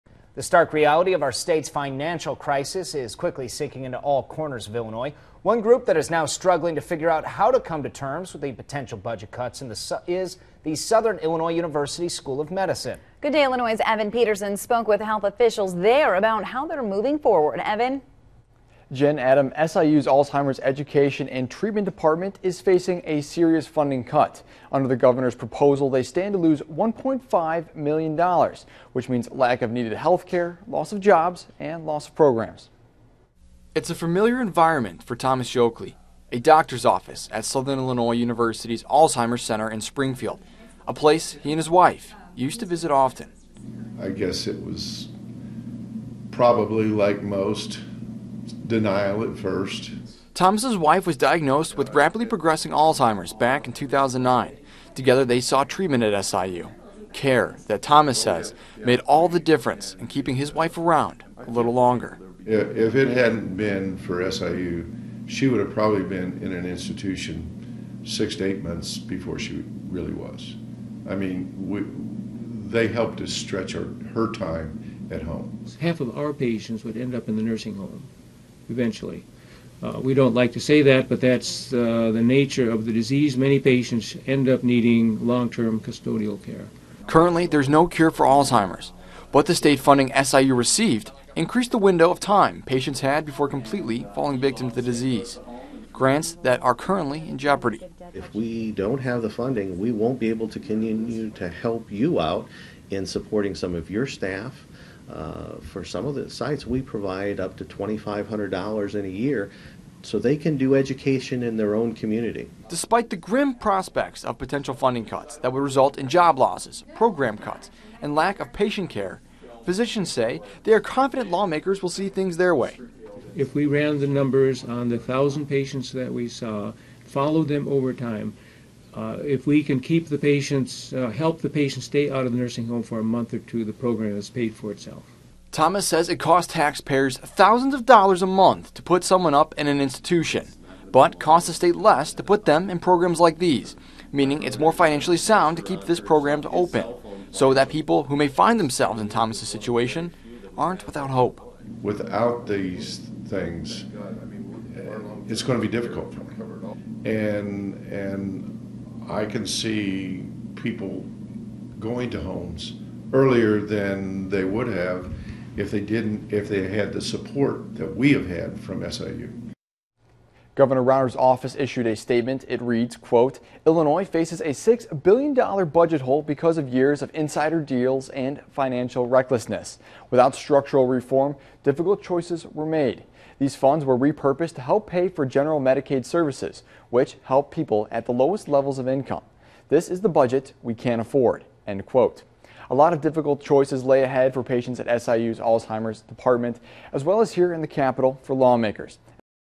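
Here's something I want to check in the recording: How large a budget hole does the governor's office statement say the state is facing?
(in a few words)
$6 billion.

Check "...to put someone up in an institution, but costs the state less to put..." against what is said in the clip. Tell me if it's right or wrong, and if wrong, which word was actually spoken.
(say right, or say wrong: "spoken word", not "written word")
right.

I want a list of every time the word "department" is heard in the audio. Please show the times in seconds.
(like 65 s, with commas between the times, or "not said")
21 s, 196 s.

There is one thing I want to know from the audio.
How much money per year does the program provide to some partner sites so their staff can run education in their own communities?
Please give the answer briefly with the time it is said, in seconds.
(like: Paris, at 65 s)
$2,500, at 107 s.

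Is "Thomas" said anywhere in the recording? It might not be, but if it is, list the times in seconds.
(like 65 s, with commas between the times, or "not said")
35 s, 50 s, 57 s, 135 s, 149 s.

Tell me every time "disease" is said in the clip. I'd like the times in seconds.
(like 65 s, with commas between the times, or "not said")
82 s, 94 s.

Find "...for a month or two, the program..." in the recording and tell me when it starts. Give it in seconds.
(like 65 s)
132 s.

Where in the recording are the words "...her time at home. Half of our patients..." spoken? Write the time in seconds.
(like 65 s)
74 s.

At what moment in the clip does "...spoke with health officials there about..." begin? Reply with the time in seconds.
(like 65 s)
14 s.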